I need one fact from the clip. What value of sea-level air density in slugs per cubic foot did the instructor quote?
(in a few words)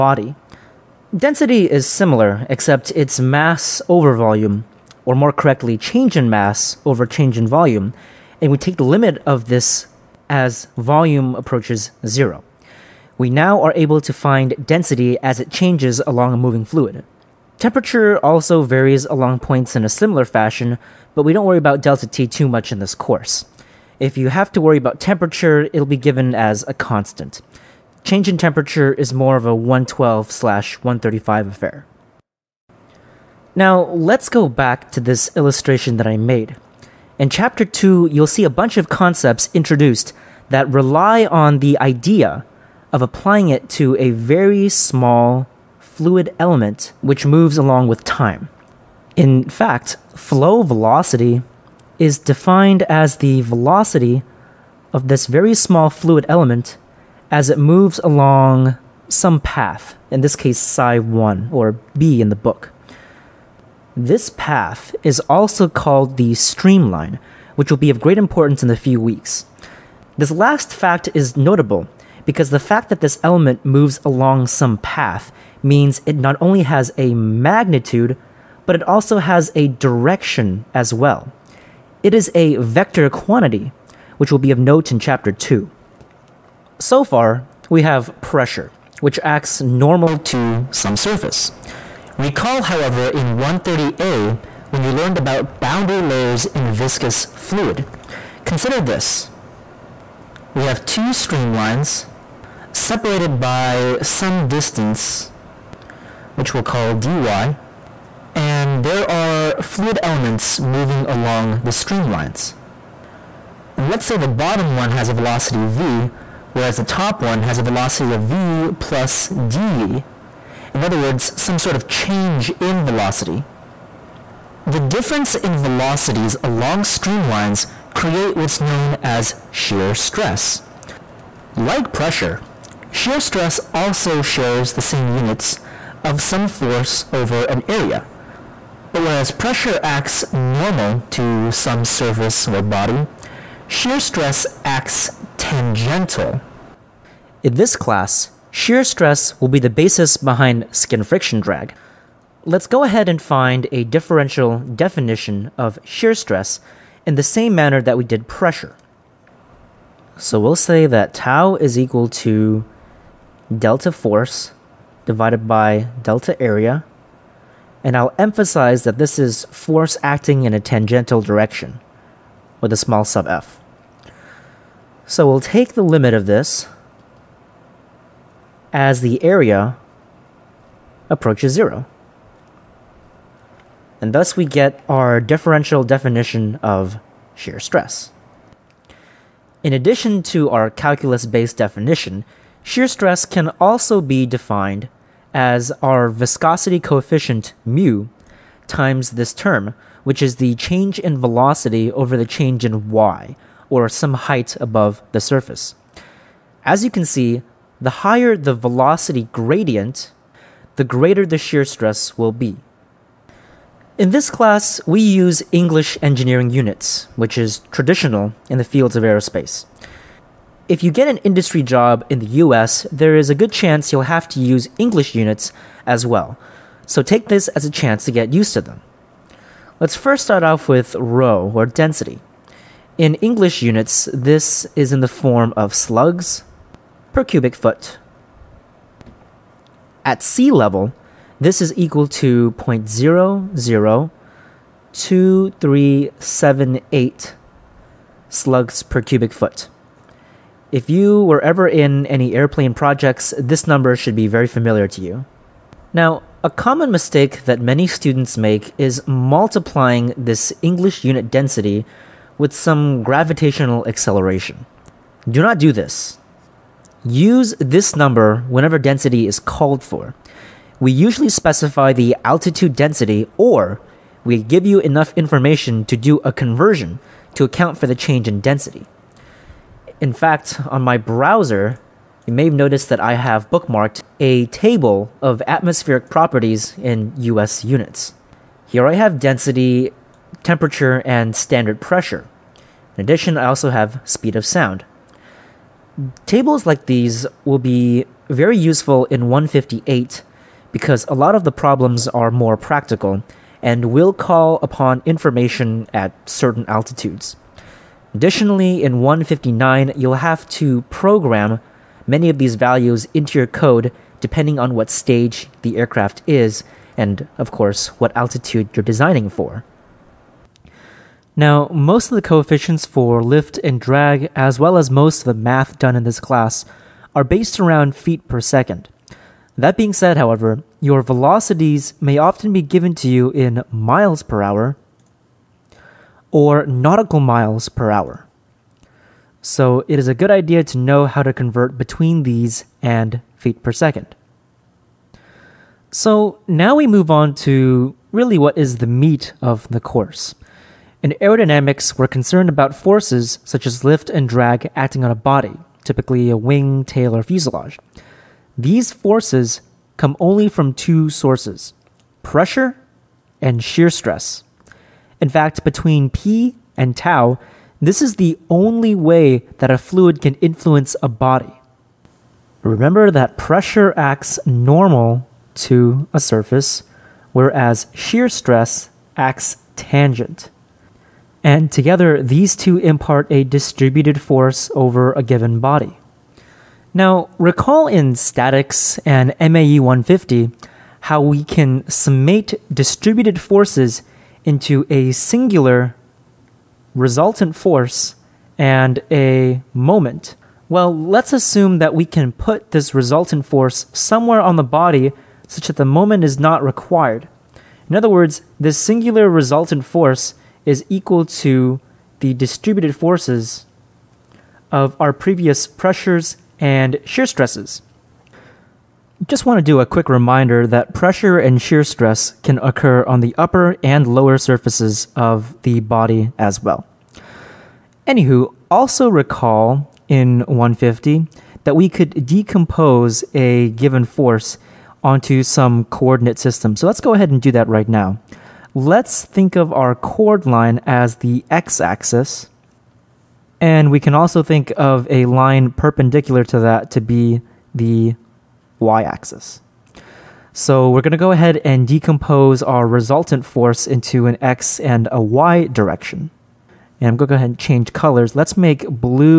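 0.002378.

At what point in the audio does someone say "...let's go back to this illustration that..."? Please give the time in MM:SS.
00:33.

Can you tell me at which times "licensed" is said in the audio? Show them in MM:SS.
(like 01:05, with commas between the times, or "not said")
not said.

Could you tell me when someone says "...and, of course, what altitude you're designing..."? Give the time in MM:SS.
05:16.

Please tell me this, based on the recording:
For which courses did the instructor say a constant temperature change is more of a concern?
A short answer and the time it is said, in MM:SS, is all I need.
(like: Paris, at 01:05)
112/135, at 00:29.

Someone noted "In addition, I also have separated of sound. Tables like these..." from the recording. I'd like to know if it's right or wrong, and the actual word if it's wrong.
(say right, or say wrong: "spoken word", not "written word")
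wrong: "speed", not "separated".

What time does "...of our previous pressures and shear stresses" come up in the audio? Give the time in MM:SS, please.
06:54.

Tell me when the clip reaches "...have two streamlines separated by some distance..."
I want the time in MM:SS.
01:40.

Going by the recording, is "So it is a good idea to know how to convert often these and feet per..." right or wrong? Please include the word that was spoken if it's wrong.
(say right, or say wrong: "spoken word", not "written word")
wrong: "between", not "often".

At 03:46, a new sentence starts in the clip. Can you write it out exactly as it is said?
So take this as a chance to get used to them.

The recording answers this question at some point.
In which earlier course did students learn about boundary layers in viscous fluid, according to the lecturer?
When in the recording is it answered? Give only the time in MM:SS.
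01:33.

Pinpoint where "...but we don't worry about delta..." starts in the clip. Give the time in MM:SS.
00:21.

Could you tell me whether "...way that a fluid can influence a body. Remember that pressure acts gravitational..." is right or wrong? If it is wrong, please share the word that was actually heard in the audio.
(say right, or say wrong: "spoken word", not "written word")
wrong: "normal", not "gravitational".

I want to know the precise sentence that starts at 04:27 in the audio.
Use this number whenever density is called for.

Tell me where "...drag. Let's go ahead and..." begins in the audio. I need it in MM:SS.
02:31.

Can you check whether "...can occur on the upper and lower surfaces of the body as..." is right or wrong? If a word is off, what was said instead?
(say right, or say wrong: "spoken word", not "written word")
right.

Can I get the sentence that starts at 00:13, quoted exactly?
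We now are able to find density as it changes along a moving fluid.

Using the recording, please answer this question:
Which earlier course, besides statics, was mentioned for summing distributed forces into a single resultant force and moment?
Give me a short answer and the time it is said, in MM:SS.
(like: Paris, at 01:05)
MAE 150, at 06:29.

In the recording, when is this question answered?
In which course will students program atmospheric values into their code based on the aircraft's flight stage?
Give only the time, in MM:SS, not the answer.
05:09.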